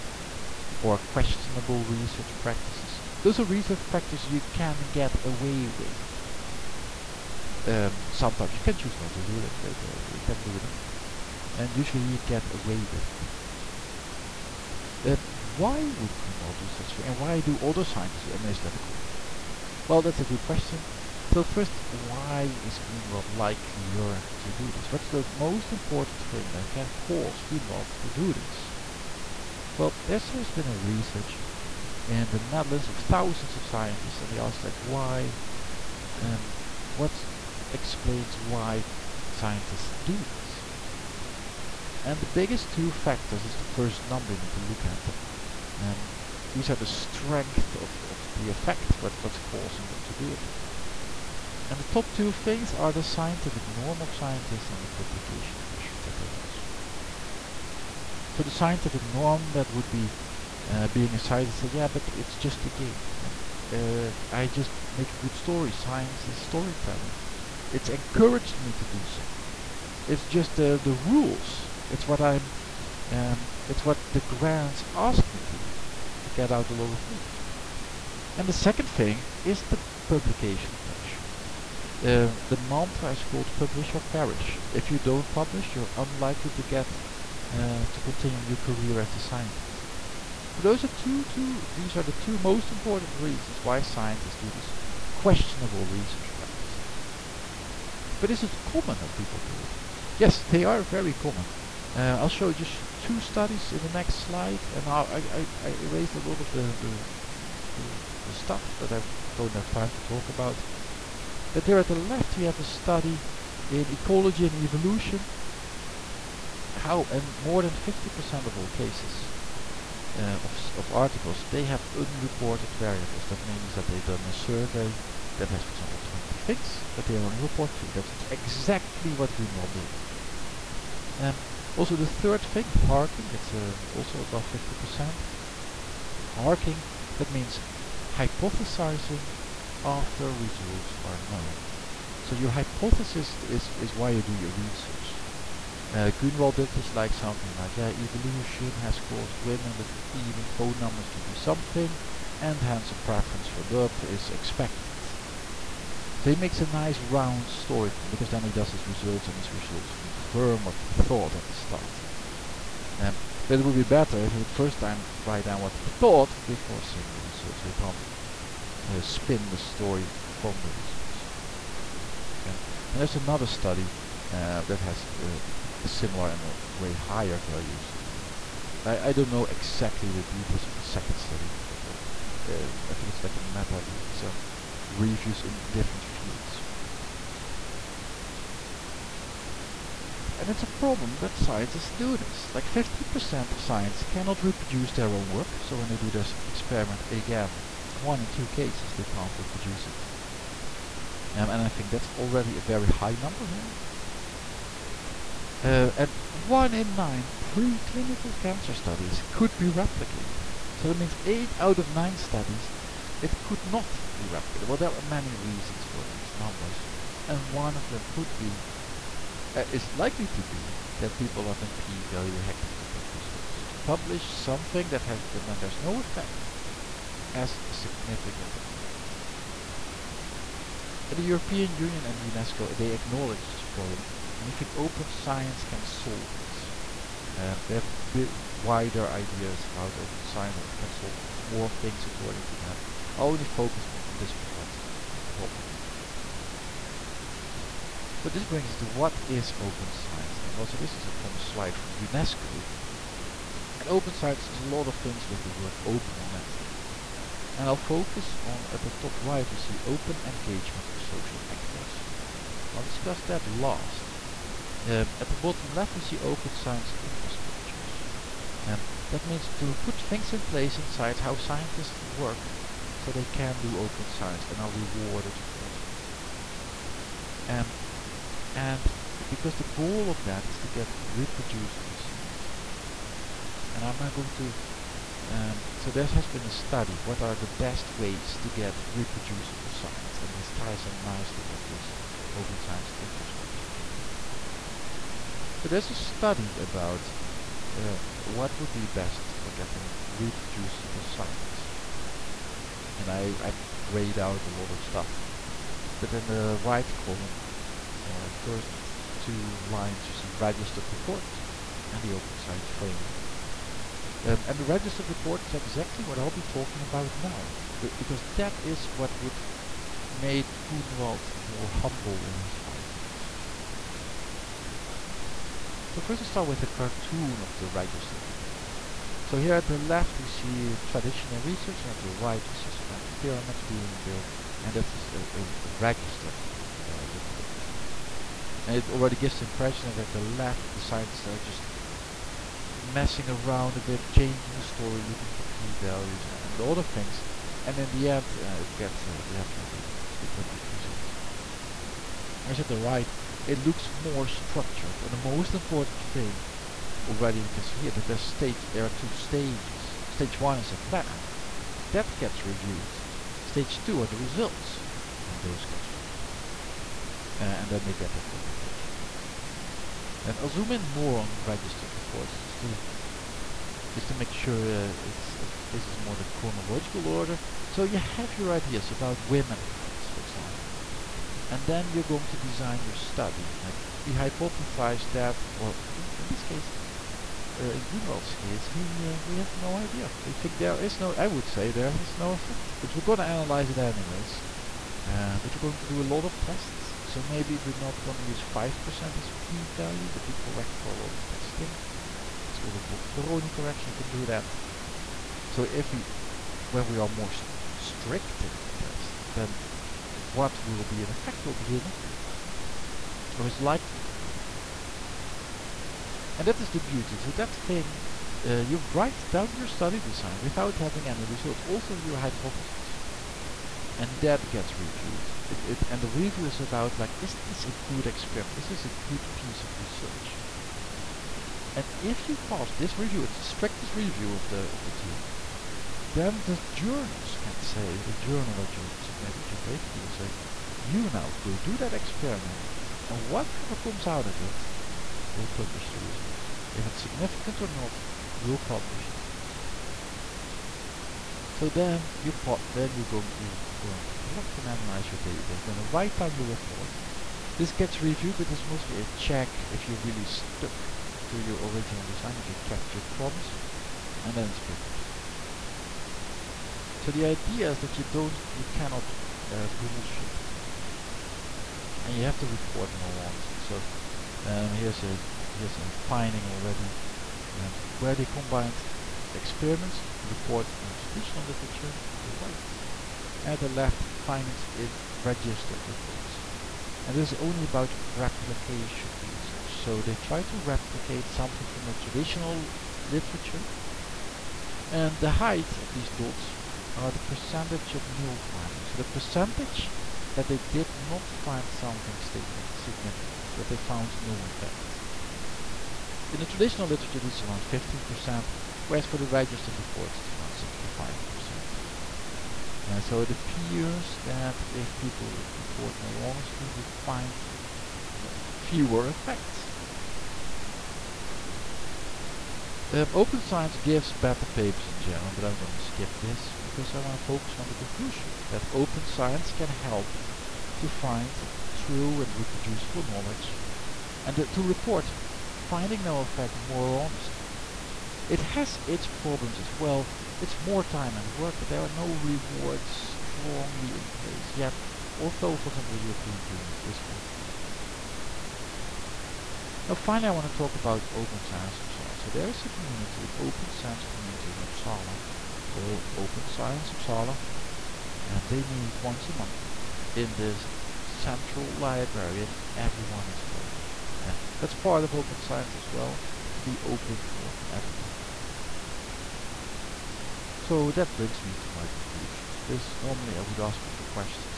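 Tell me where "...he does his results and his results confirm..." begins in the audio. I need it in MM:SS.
02:38.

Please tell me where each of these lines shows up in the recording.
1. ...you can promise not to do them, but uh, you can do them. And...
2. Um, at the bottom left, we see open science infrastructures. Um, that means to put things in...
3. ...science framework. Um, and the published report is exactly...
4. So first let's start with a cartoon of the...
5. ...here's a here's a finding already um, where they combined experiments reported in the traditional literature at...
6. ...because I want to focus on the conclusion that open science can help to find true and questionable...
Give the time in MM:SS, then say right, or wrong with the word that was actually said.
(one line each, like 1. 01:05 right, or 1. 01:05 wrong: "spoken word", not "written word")
1. 00:08 wrong: "choose", not "promise"
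2. 04:24 right
3. 05:12 wrong: "registered", not "published"
4. 05:25 right
5. 07:54 right
6. 08:46 wrong: "reproducible", not "questionable".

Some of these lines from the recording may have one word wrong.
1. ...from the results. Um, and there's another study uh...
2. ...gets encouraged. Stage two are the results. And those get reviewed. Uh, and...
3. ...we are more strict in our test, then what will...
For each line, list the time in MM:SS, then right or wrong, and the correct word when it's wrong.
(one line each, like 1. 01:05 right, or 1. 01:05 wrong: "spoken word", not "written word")
1. 02:50 right
2. 06:02 wrong: "reviewed", not "encouraged"
3. 06:46 right.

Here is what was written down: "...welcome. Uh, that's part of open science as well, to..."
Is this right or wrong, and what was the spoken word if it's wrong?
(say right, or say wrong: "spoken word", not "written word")
right.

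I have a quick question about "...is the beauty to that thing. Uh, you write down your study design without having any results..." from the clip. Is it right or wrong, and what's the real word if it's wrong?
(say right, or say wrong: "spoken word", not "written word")
right.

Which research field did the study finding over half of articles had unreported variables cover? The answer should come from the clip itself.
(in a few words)
ecology and evolution.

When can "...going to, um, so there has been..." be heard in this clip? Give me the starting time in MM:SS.
04:44.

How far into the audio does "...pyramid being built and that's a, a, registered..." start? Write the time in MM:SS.
05:33.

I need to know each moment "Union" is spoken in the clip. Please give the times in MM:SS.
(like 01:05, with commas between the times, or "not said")
03:51, 09:06.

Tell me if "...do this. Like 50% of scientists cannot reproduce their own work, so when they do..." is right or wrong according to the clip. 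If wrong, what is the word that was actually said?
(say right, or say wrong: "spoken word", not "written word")
right.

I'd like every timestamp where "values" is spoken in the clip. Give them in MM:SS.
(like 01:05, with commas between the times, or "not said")
02:57, 03:41, 05:45, 06:39.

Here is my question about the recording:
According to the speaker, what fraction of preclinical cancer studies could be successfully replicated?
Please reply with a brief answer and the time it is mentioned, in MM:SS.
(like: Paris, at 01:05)
1 in 9, at 03:26.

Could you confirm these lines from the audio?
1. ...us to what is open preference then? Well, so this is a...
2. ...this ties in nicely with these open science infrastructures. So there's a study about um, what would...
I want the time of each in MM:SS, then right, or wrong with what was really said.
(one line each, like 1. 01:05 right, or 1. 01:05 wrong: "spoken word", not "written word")
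1. 04:08 wrong: "science", not "preference"
2. 04:50 right.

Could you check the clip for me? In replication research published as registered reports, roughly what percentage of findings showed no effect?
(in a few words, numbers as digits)
65%.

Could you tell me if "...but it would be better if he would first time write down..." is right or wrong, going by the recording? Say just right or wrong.
right.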